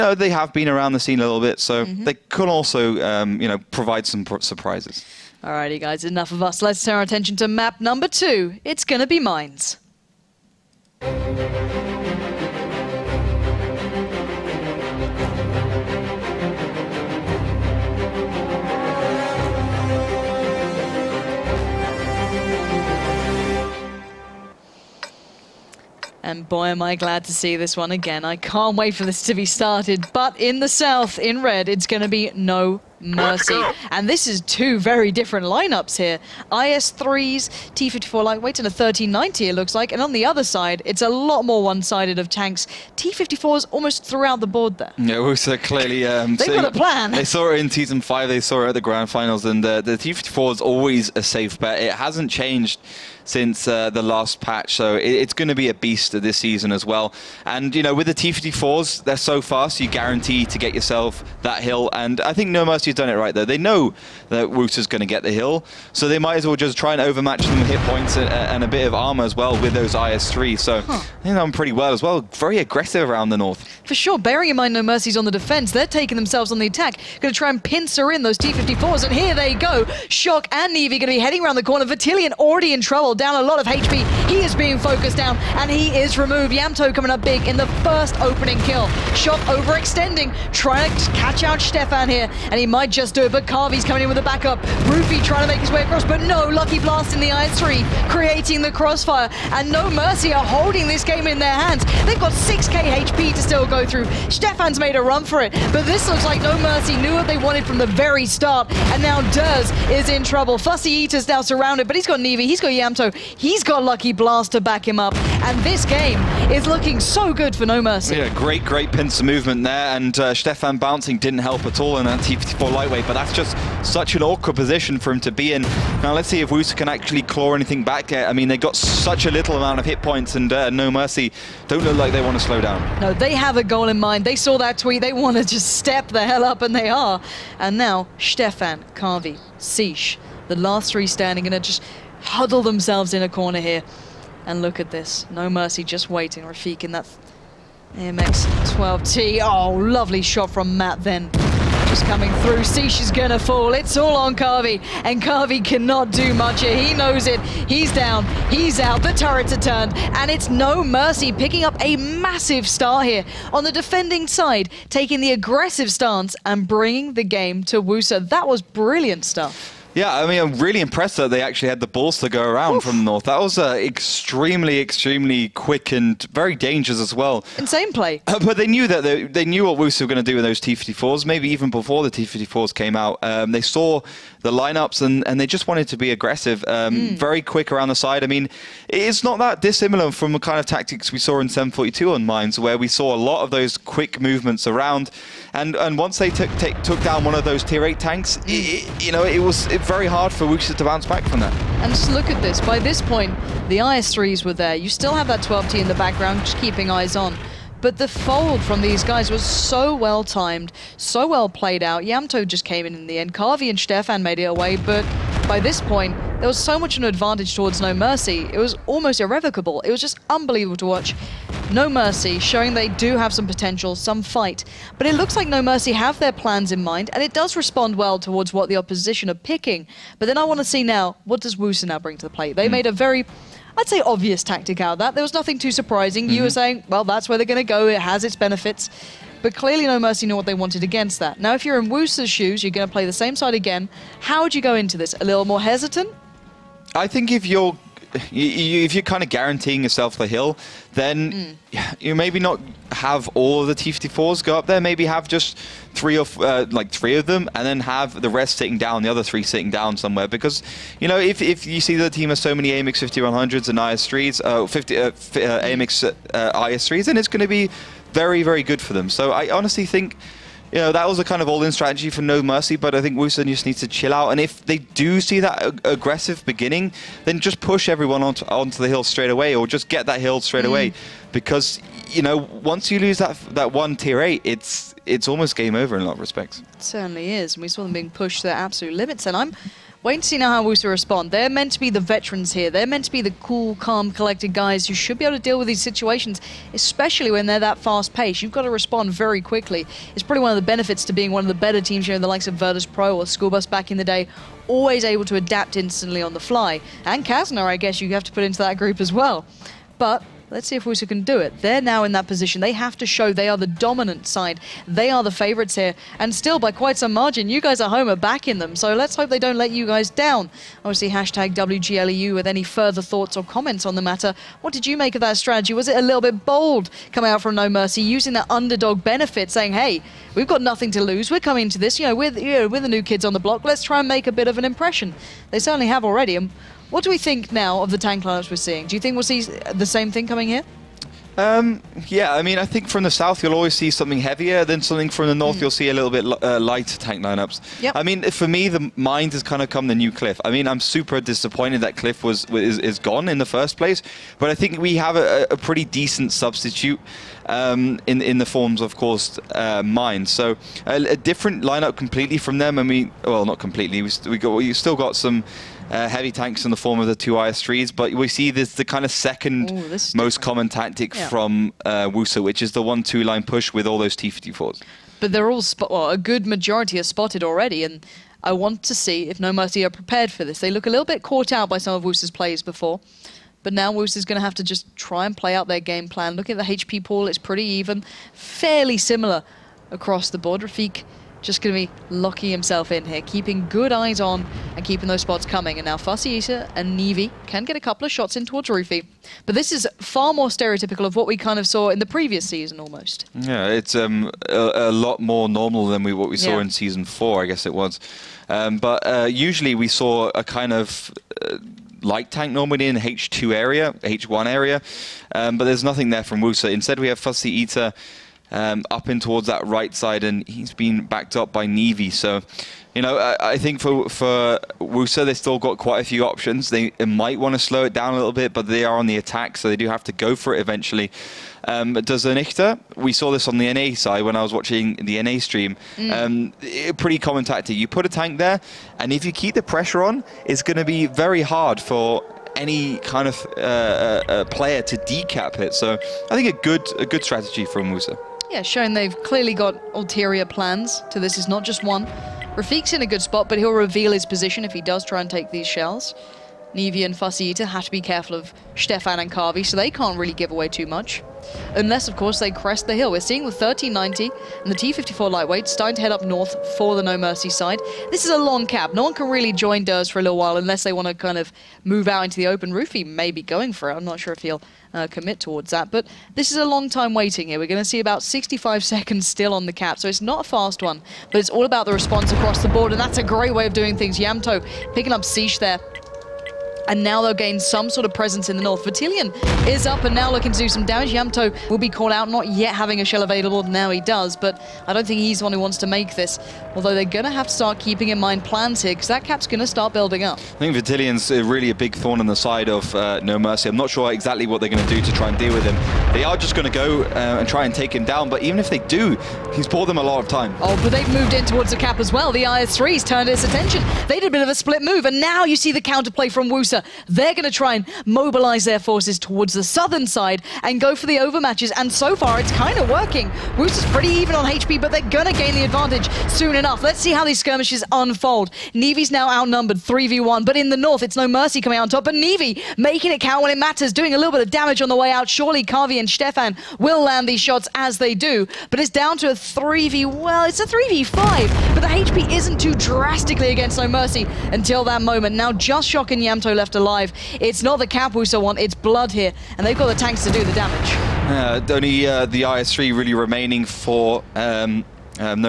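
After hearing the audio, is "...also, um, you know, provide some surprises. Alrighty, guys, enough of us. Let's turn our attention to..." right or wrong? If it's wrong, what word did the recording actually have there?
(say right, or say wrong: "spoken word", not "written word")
right.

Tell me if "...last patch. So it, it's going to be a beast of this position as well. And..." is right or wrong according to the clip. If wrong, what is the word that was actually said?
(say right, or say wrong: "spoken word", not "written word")
wrong: "season", not "position".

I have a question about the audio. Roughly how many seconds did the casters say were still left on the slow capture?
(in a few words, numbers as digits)
65.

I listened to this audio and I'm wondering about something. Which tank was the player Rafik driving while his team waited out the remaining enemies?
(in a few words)
AMX-12T.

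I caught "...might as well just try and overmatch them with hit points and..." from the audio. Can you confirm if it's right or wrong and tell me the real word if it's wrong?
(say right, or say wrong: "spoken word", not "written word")
right.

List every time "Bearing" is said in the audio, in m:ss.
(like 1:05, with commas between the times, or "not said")
1:14.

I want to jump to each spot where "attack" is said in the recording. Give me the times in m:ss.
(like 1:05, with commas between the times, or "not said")
1:16, 7:09.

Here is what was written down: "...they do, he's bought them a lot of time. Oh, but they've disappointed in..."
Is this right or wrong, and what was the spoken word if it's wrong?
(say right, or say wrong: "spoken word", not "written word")
wrong: "moved", not "disappointed".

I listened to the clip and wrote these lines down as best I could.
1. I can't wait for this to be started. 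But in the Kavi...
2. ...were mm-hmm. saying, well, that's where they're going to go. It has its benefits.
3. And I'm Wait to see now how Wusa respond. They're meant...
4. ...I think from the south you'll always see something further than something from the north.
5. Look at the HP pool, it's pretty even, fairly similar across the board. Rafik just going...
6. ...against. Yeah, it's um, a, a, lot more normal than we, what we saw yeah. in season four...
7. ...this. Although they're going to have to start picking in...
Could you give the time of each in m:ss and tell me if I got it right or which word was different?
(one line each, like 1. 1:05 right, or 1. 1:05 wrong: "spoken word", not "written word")
1. 0:28 wrong: "South", not "Kavi"
2. 3:56 right
3. 4:49 right
4. 5:42 wrong: "heavier", not "further"
5. 6:26 right
6. 6:42 wrong: "almost", not "against"
7. 8:16 wrong: "keeping", not "picking".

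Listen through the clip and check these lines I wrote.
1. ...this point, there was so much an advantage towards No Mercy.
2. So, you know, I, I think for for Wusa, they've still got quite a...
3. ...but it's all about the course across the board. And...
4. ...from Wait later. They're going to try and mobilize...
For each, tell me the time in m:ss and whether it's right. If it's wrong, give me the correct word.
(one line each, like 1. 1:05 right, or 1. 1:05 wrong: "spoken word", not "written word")
1. 3:35 right
2. 7:02 right
3. 8:01 wrong: "response", not "course"
4. 8:36 wrong: "Wusa", not "Wait".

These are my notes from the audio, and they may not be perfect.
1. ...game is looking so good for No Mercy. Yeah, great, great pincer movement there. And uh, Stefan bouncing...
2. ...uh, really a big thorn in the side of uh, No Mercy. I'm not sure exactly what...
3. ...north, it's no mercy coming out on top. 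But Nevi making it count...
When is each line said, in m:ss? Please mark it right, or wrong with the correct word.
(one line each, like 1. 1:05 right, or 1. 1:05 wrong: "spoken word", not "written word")
1. 1:55 right
2. 8:21 right
3. 8:50 right.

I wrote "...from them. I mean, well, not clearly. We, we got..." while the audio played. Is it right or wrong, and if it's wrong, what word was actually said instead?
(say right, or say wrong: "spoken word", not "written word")
wrong: "completely", not "clearly".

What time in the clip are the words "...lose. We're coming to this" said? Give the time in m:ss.
5:31.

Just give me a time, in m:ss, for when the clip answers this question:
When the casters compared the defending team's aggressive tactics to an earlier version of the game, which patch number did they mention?
3:11.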